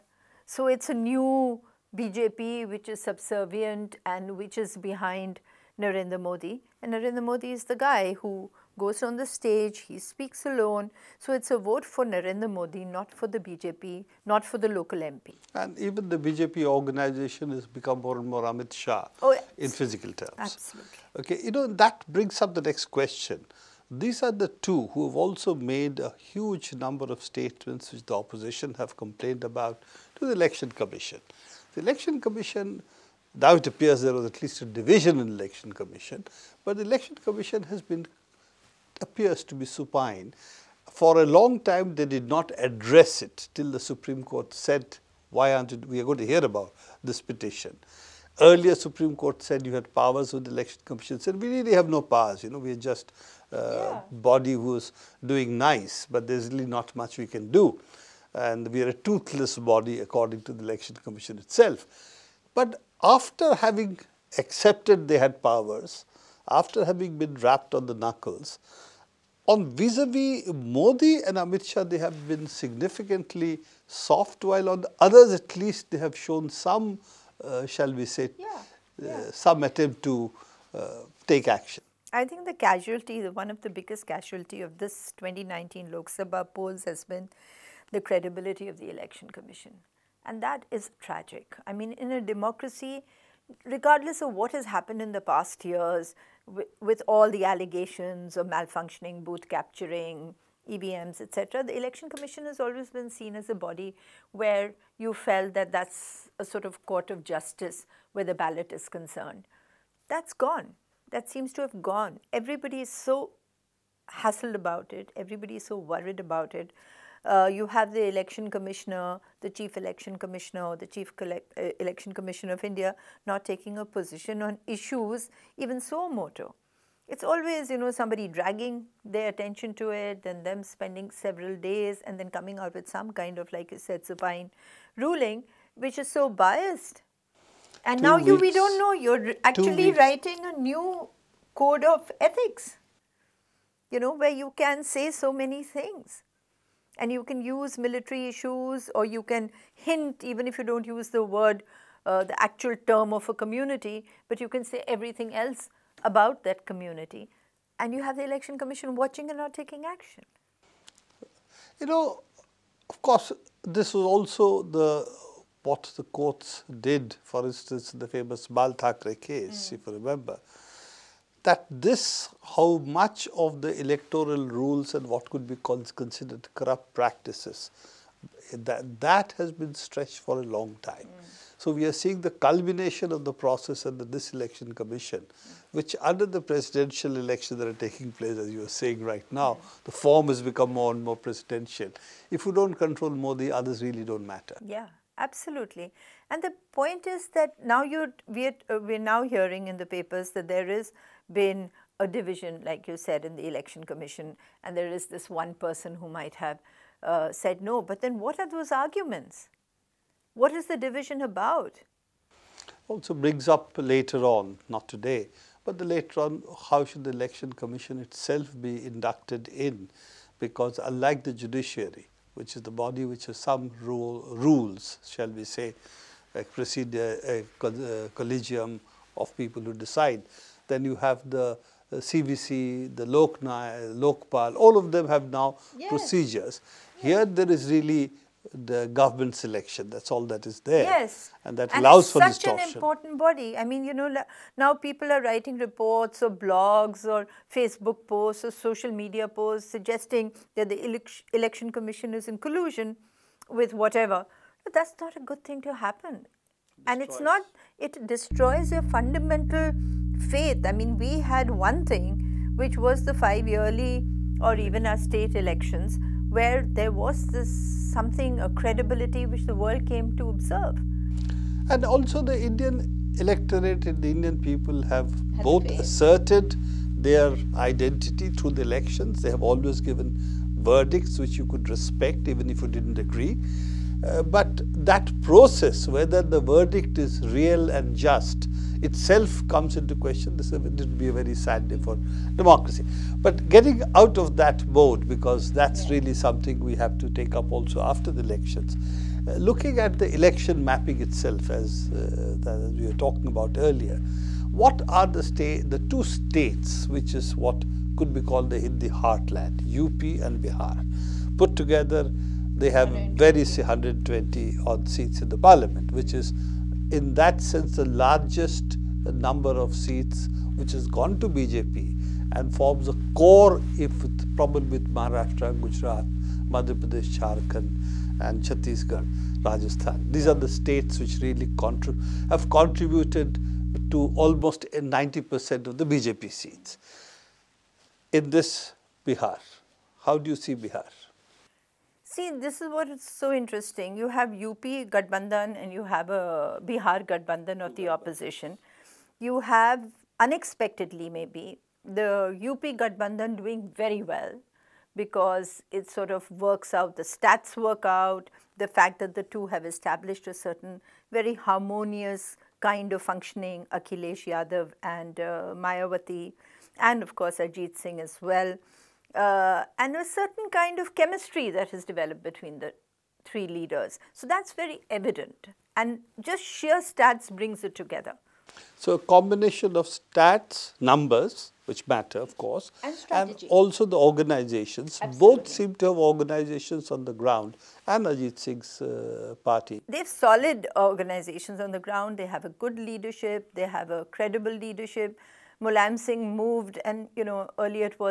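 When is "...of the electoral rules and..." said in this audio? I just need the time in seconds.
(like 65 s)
173 s.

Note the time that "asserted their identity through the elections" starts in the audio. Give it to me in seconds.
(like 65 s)
275 s.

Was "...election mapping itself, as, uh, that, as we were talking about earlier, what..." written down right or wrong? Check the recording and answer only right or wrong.
right.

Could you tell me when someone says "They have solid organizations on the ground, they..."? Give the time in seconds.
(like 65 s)
389 s.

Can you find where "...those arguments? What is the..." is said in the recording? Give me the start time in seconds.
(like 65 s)
208 s.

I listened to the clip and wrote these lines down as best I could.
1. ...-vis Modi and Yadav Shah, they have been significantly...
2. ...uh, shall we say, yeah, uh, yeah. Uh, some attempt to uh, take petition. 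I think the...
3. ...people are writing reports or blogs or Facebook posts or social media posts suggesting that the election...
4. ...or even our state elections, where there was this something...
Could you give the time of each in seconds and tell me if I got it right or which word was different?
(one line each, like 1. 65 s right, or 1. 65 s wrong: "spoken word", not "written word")
1. 70 s wrong: "Amit", not "Yadav"
2. 77 s wrong: "action", not "petition"
3. 244 s right
4. 264 s right.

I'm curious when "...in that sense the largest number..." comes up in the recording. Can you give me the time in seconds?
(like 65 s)
316 s.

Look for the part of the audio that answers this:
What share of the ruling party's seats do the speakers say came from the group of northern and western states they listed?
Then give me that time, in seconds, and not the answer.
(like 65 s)
334 s.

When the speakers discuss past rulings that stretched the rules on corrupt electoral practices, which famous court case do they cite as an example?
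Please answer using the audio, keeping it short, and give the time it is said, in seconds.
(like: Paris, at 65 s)
Bal Thackeray case, at 168 s.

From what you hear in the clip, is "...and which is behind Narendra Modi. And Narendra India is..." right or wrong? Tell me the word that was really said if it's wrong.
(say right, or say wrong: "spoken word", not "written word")
wrong: "Modi", not "India".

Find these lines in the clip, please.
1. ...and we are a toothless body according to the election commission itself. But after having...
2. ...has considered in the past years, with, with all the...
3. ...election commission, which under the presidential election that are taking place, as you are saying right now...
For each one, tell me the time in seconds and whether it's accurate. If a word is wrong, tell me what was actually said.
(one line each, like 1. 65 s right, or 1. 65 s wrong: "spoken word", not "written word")
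1. 58 s right
2. 94 s wrong: "happened", not "considered"
3. 184 s right.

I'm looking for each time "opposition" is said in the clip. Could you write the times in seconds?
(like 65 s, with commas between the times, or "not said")
28 s, 347 s.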